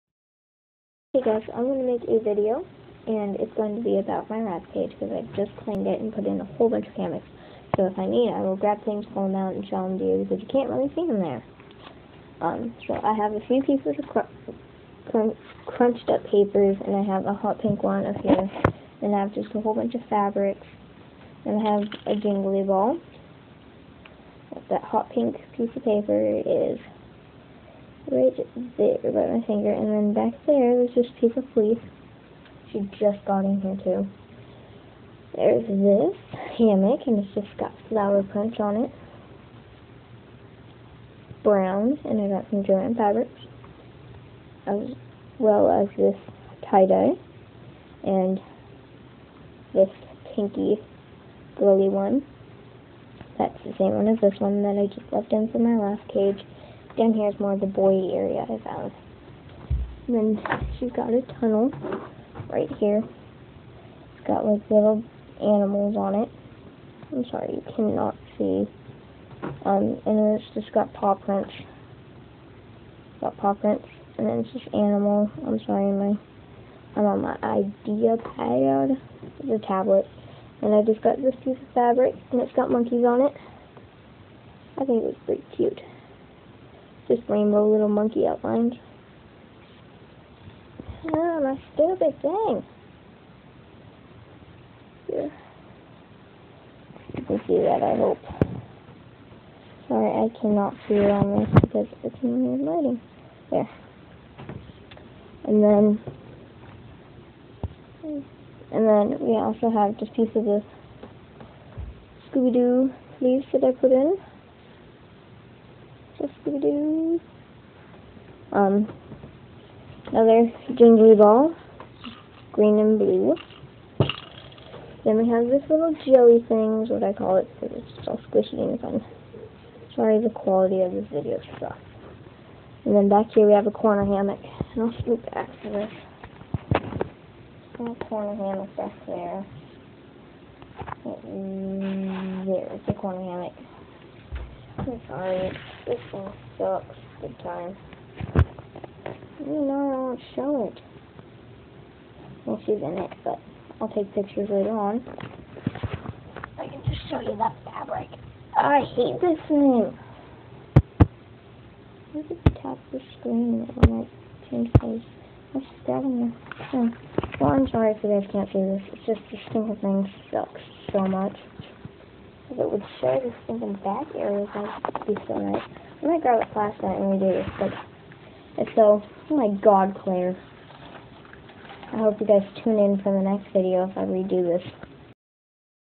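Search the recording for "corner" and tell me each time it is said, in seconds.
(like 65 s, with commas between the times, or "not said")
133 s, 138 s, 142 s.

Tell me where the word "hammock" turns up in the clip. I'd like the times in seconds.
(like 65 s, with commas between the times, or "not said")
6 s, 36 s, 134 s, 138 s, 143 s.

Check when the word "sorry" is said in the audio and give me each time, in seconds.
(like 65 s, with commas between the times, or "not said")
67 s, 75 s, 99 s, 129 s, 145 s, 167 s.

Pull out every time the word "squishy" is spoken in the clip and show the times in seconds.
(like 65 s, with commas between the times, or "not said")
128 s.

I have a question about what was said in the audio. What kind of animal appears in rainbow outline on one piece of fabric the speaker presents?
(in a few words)
Monkeys.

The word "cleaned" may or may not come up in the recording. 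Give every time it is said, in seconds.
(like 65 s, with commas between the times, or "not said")
5 s.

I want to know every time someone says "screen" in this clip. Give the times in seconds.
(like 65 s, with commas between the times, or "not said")
163 s.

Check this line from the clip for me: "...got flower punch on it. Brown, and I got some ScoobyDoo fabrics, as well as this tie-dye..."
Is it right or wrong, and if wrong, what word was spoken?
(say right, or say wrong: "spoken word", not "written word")
wrong: "Joann", not "ScoobyDoo".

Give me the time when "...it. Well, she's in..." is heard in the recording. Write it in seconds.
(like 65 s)
150 s.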